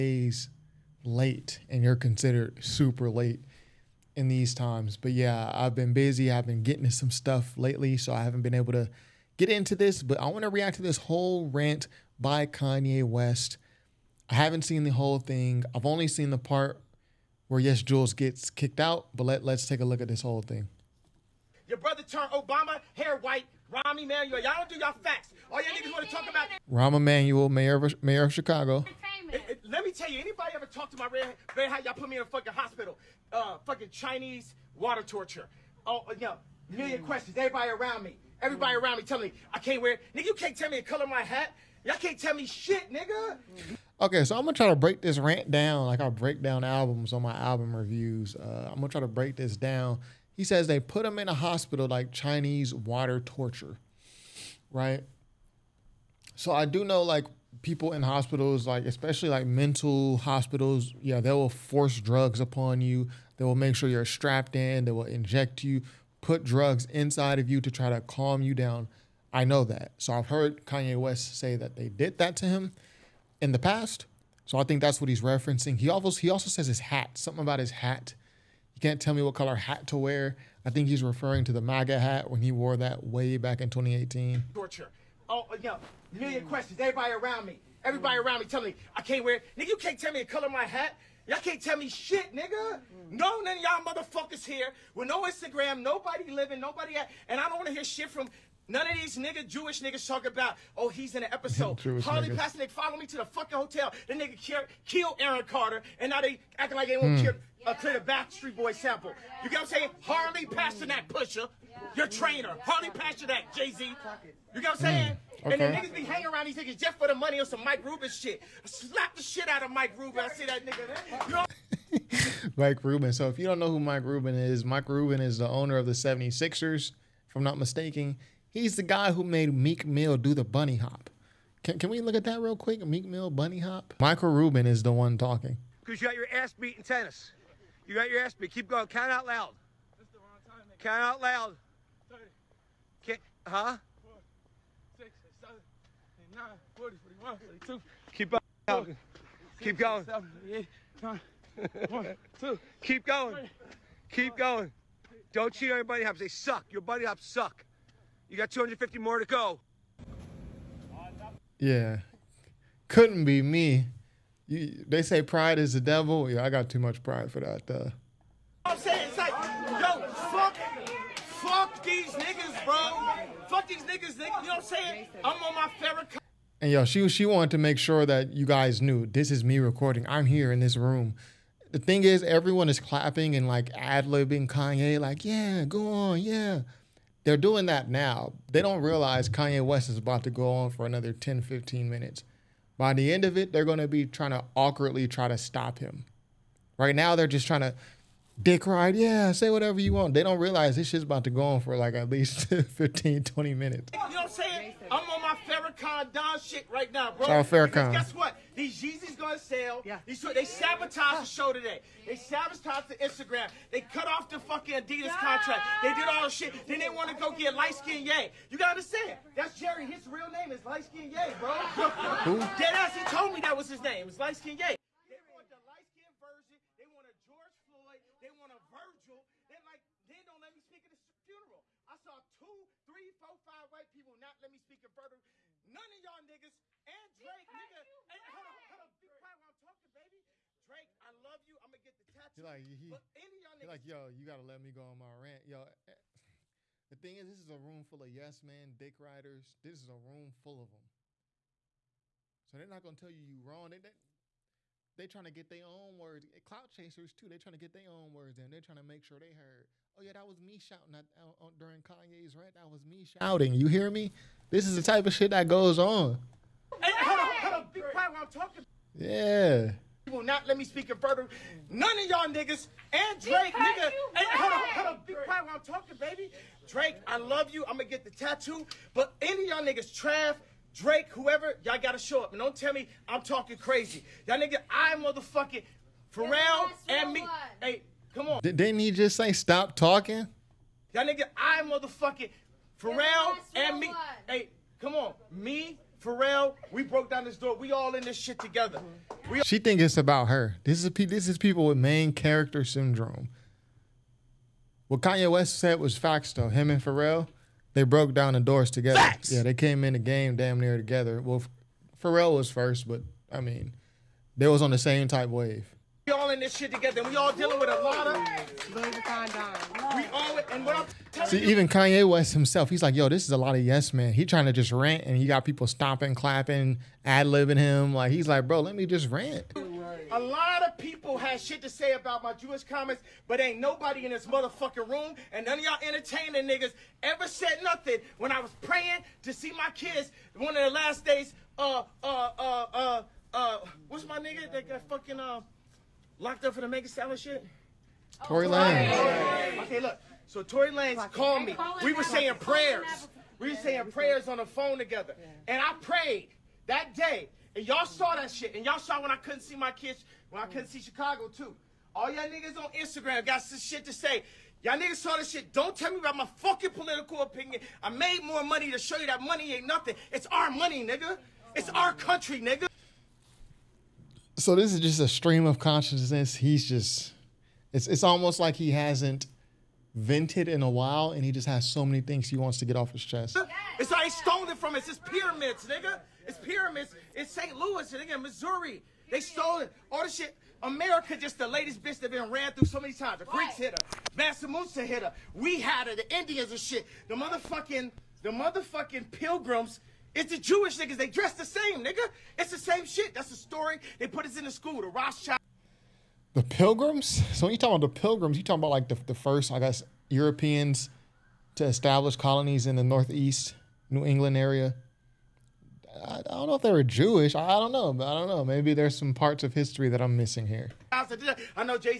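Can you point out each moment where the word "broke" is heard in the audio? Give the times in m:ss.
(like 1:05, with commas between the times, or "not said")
4:56, 5:07.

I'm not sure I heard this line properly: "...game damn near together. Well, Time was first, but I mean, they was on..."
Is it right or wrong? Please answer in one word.
wrong.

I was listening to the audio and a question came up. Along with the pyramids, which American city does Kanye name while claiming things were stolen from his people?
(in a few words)
St. Louis.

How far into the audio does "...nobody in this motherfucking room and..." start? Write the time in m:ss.
5:33.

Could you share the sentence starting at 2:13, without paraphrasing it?
Michael Rubin is the one talking.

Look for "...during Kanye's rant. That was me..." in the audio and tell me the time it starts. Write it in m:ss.
4:21.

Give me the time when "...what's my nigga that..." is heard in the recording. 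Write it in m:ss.
5:43.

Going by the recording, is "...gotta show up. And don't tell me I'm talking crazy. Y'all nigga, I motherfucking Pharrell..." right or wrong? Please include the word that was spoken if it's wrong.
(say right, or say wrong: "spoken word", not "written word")
right.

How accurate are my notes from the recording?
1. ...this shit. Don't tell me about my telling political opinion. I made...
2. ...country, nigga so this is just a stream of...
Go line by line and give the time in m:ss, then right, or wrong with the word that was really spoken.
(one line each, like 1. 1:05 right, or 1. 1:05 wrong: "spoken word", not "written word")
1. 6:05 wrong: "fucking", not "telling"
2. 6:11 right.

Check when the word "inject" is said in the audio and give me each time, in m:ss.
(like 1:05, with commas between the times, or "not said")
1:05.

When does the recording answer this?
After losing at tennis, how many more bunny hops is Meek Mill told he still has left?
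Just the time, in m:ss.
2:38.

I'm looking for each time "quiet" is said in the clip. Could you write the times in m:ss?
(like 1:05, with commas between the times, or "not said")
3:59, 4:35.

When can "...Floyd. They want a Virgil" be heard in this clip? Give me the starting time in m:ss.
3:47.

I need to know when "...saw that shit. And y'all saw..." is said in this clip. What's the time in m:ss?
5:57.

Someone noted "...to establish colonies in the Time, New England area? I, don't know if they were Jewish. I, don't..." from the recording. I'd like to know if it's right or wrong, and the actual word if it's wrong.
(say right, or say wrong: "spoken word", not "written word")
wrong: "Northeast", not "Time".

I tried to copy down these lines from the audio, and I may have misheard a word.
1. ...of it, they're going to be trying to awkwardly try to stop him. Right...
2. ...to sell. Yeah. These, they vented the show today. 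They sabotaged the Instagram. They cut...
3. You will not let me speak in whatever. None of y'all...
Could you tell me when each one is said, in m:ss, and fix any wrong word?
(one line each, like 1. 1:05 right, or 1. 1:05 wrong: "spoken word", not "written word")
1. 3:13 right
2. 3:29 wrong: "sabotaged", not "vented"
3. 4:30 wrong: "further", not "whatever".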